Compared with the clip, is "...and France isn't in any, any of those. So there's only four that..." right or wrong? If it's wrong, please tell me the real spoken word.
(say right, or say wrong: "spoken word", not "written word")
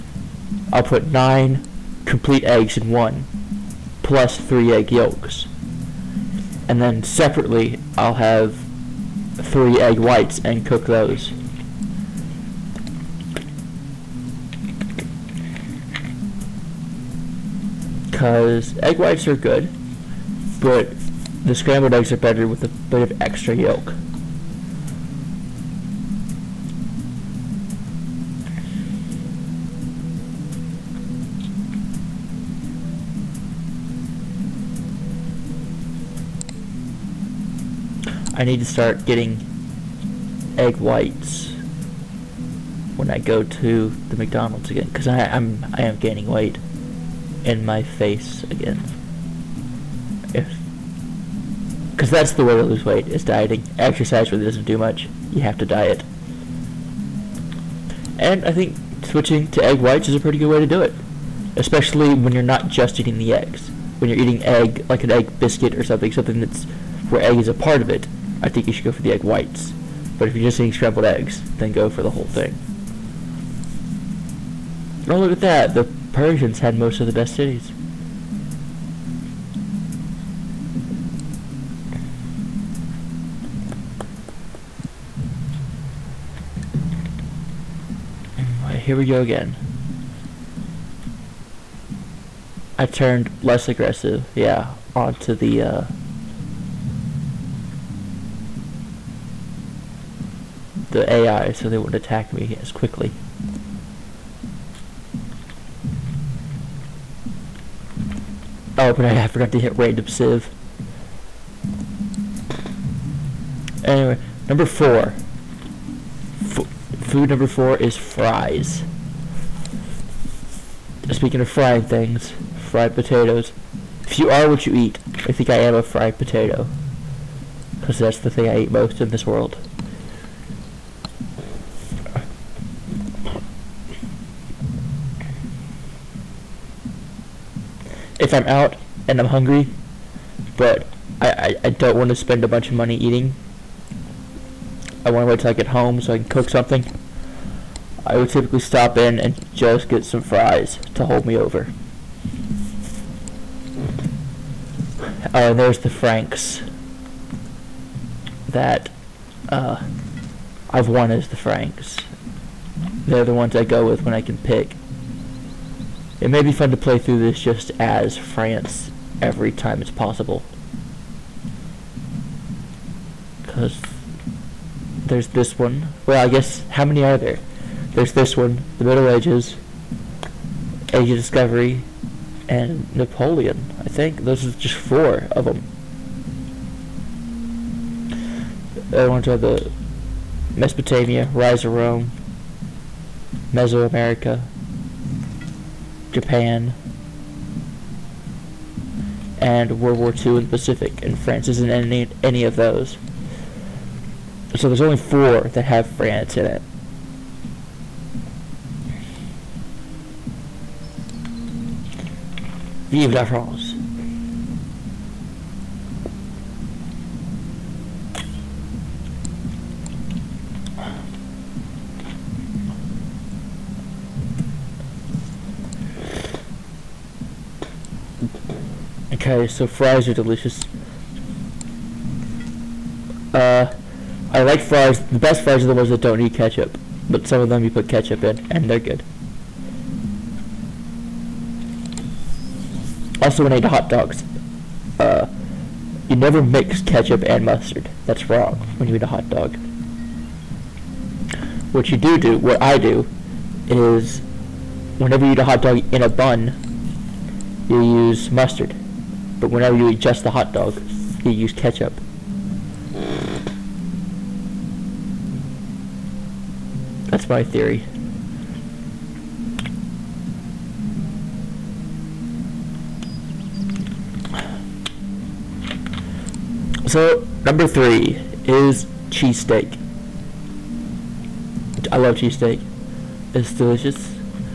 right.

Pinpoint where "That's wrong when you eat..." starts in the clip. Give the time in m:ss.
4:08.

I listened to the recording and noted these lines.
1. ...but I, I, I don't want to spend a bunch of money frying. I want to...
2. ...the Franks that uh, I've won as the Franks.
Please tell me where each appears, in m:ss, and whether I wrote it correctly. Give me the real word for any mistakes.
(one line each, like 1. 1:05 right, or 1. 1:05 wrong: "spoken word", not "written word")
1. 2:20 wrong: "eating", not "frying"
2. 2:35 right.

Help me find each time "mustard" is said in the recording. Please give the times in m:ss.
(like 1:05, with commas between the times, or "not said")
4:07, 4:18.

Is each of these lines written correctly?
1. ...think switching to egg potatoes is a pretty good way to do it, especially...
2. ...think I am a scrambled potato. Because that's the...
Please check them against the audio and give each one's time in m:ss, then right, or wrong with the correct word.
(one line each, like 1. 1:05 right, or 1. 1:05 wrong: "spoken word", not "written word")
1. 0:58 wrong: "whites", not "potatoes"
2. 2:05 wrong: "fried", not "scrambled".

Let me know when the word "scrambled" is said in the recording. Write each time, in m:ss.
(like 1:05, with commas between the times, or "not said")
0:21, 1:10.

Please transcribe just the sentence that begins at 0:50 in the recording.
If because that's the way to lose weight is dieting.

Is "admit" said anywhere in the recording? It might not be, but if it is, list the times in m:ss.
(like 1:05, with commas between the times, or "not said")
not said.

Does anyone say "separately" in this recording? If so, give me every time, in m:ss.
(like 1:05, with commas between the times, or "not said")
0:07.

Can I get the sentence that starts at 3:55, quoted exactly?
The best fries are the ones that don't need ketchup, but some of them you put ketchup in, and they're good.